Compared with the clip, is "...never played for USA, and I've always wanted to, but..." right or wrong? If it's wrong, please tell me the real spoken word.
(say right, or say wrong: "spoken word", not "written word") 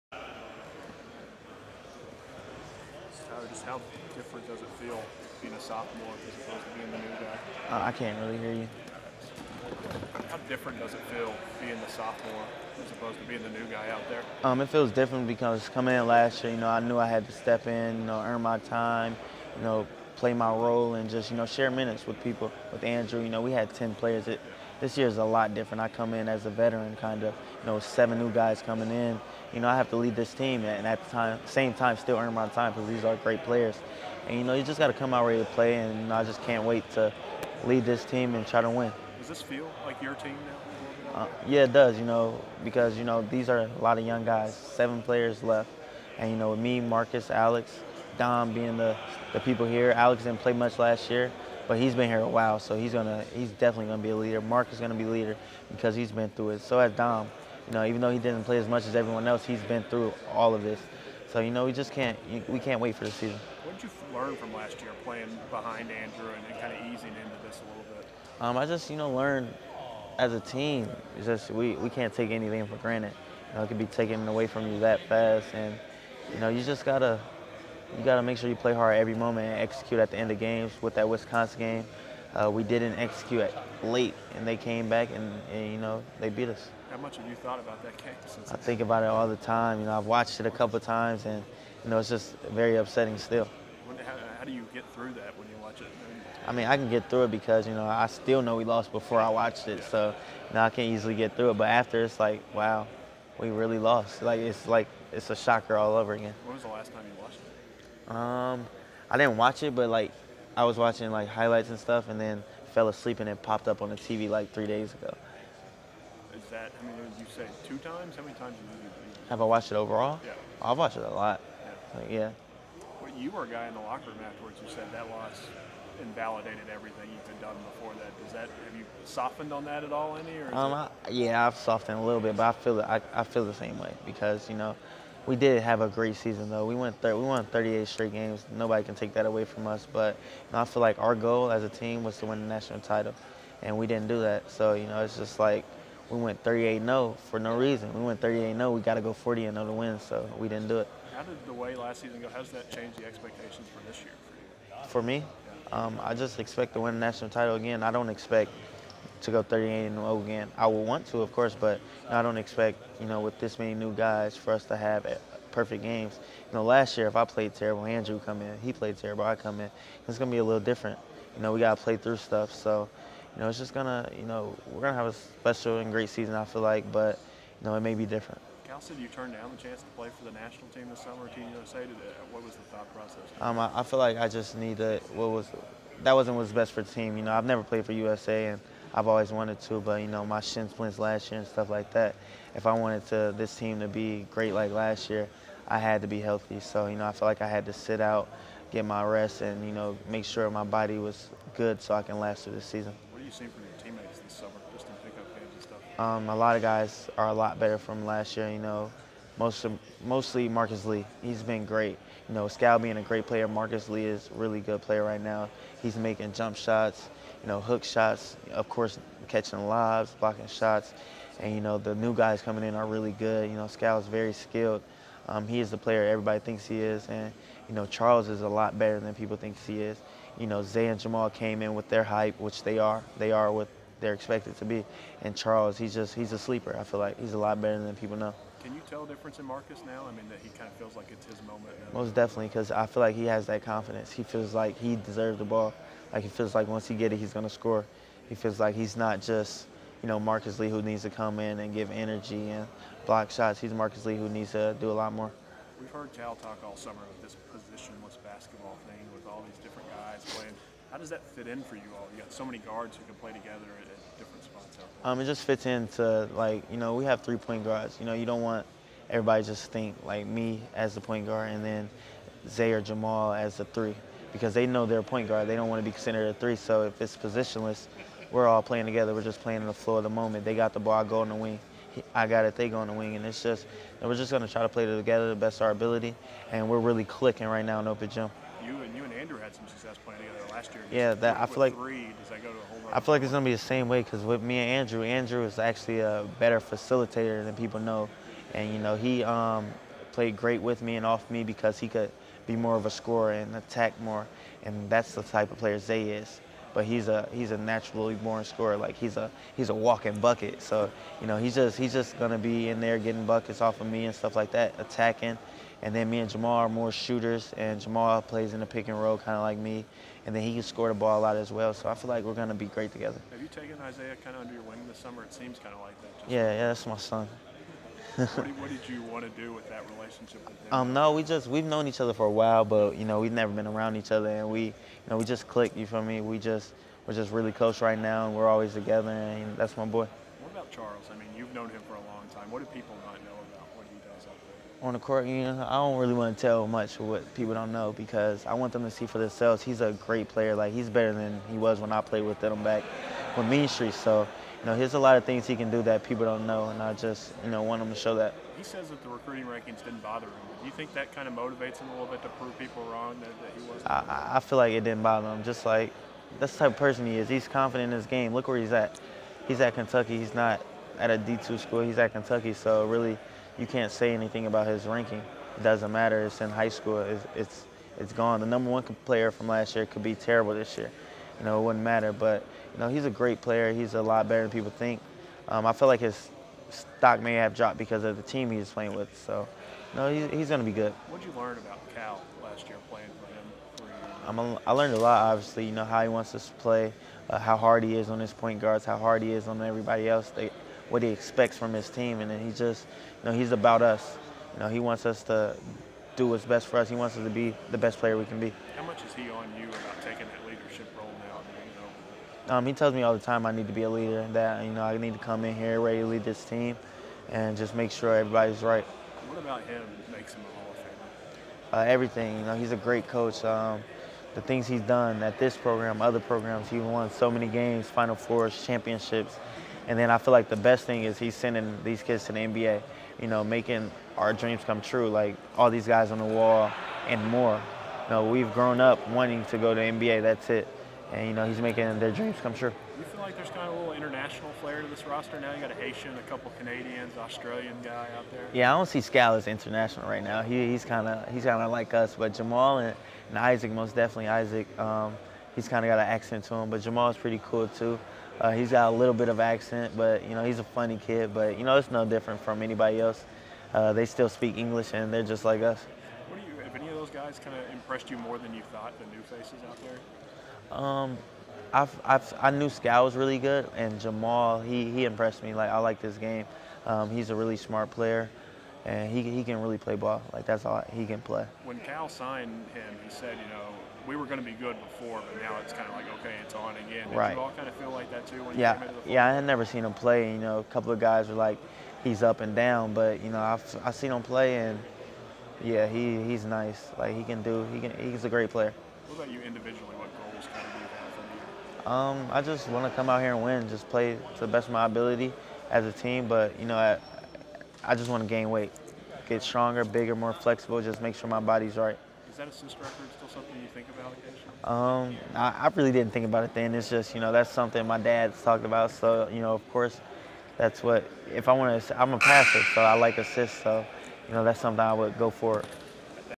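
right.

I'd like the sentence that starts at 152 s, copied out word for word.
Has that change the expectations for this year for you?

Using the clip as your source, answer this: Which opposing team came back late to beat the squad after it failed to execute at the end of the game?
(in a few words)
Wisconsin.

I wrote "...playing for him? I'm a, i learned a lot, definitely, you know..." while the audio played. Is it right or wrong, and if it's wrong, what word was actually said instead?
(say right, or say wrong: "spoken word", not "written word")
wrong: "obviously", not "definitely".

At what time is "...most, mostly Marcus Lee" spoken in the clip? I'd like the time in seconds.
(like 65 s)
209 s.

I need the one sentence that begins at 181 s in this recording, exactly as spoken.
Did, uh, what was the thought process?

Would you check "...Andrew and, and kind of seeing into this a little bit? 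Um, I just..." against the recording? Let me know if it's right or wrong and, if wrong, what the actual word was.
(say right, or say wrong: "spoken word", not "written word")
wrong: "easing", not "seeing".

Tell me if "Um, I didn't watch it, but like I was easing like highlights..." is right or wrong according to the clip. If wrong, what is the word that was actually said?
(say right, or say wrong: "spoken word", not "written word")
wrong: "watching", not "easing".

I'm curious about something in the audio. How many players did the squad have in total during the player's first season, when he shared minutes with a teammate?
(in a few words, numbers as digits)
10.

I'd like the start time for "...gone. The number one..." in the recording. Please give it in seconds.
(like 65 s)
378 s.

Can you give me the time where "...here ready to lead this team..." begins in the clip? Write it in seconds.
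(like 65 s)
415 s.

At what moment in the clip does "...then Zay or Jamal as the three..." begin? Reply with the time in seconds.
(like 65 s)
271 s.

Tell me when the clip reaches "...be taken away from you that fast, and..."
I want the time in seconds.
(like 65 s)
73 s.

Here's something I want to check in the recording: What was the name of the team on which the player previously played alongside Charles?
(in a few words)
Mean Street.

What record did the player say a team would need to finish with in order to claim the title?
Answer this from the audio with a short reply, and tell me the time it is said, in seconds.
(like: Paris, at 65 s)
40-0, at 149 s.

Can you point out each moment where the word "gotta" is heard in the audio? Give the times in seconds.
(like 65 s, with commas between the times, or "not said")
76 s, 171 s.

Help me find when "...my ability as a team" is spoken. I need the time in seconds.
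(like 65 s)
504 s.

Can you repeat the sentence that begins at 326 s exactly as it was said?
yeah, yeah, that's my son what, what, did you want to do with that relationship with him?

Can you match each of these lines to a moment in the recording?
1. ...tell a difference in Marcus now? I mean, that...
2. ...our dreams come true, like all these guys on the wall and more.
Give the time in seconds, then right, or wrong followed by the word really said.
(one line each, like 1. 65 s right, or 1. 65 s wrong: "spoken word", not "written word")
1. 238 s right
2. 434 s right.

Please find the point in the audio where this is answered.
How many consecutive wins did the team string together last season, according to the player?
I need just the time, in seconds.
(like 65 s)
136 s.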